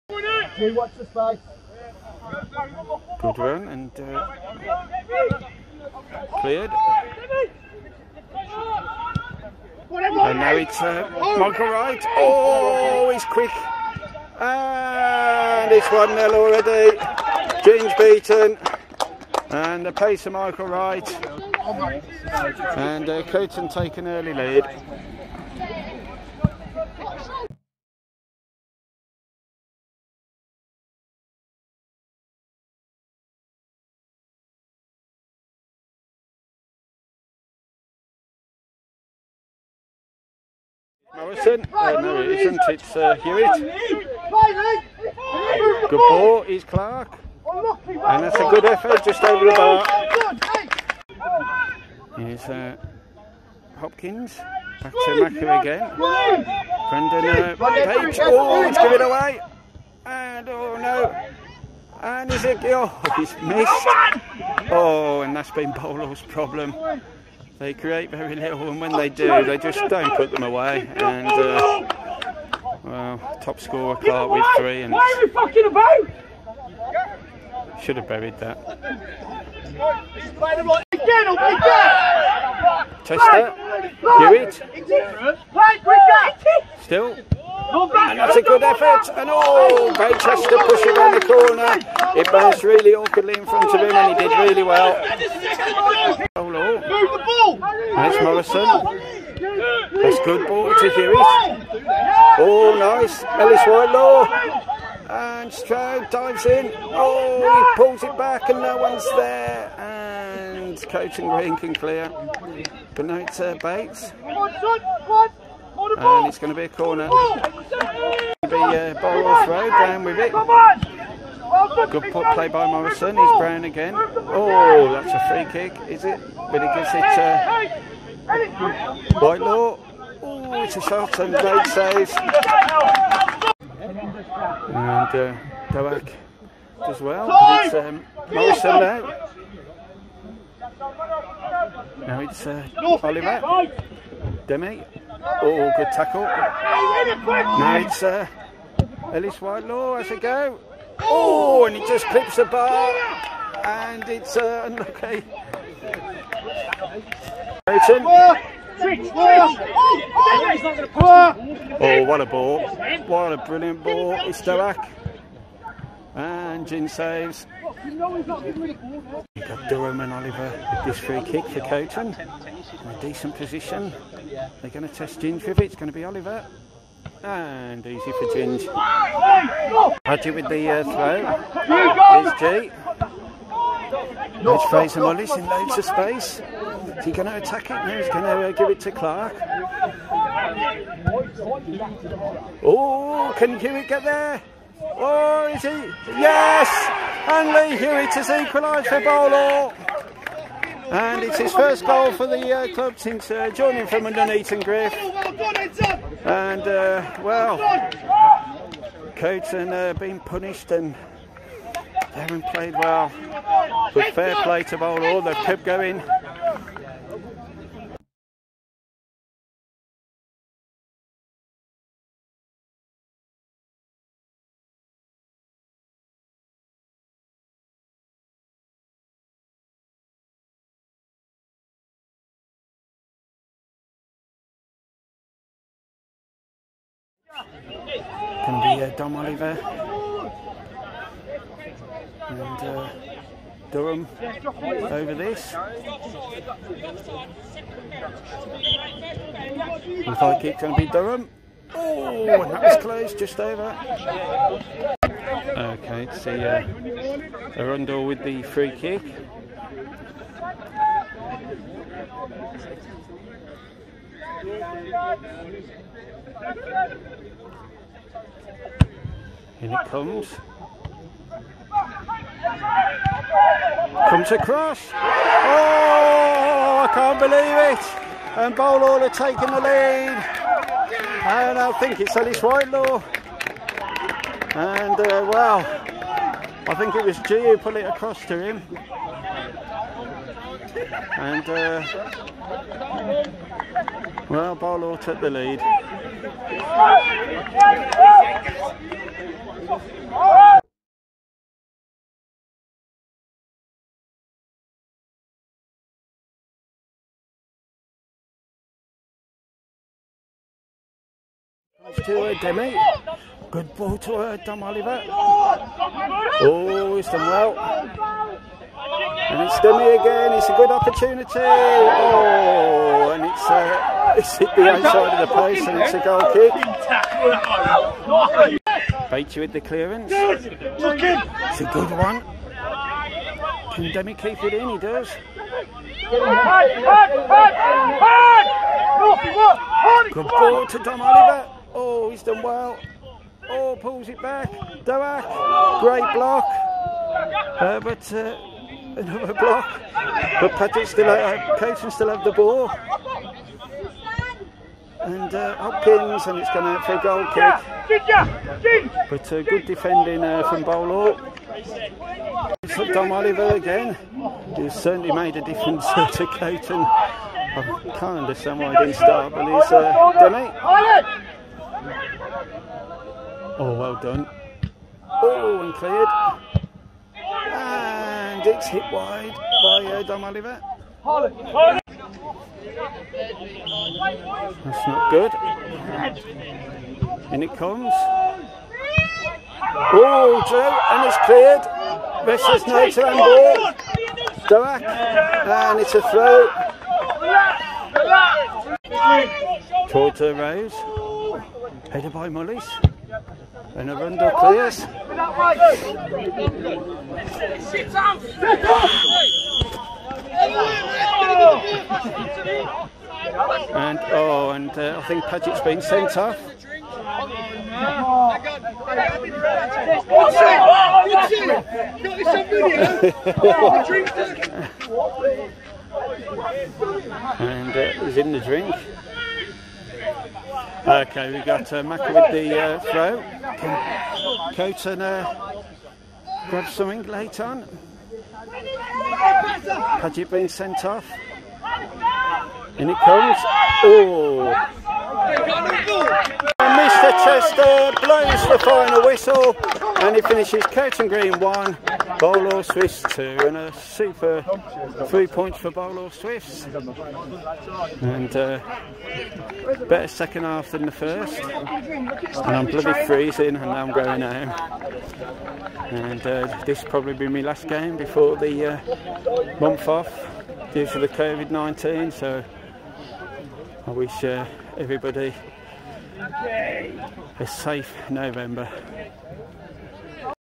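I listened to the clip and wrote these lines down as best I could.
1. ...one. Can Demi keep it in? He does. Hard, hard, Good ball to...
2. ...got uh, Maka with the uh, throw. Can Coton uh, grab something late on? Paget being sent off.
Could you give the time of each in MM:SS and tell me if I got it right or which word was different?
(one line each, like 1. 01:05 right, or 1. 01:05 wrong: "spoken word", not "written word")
1. 05:31 right
2. 07:11 right.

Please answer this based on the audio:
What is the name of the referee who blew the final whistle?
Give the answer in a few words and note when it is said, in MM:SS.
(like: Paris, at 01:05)
Mr. Chester, at 07:26.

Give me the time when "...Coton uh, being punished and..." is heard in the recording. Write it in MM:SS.
03:29.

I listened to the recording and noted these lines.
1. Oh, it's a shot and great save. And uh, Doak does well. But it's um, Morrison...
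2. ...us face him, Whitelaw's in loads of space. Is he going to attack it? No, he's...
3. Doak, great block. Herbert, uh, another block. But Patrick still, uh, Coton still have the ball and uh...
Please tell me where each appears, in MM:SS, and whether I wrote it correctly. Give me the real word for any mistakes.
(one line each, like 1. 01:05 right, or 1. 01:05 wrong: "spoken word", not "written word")
1. 02:10 right
2. 03:04 wrong: "Molly", not "Whitelaw"
3. 05:44 right.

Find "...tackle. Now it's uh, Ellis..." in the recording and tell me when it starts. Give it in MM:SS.
02:25.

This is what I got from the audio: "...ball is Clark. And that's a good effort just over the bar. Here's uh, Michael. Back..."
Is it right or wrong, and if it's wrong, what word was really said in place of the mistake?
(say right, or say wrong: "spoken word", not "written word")
wrong: "Hopkins", not "Michael".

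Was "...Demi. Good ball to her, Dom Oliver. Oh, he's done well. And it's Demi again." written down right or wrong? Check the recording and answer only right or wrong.
right.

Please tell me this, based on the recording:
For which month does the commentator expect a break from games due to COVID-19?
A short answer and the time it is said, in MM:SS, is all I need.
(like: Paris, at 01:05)
November, at 07:58.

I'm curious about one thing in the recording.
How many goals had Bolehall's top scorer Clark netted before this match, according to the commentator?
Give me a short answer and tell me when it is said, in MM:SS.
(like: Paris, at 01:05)
3, at 01:14.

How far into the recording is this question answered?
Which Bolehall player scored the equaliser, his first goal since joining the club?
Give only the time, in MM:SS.
03:17.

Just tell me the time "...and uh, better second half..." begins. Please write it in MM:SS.
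07:38.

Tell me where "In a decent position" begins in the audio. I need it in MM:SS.
02:52.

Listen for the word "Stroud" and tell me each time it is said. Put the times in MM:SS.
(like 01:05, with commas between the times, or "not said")
01:45.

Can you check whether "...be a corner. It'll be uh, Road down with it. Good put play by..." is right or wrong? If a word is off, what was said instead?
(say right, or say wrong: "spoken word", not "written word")
right.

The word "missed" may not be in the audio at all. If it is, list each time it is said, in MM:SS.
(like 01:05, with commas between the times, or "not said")
01:03.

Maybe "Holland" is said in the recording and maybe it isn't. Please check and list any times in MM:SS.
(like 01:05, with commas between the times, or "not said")
06:21.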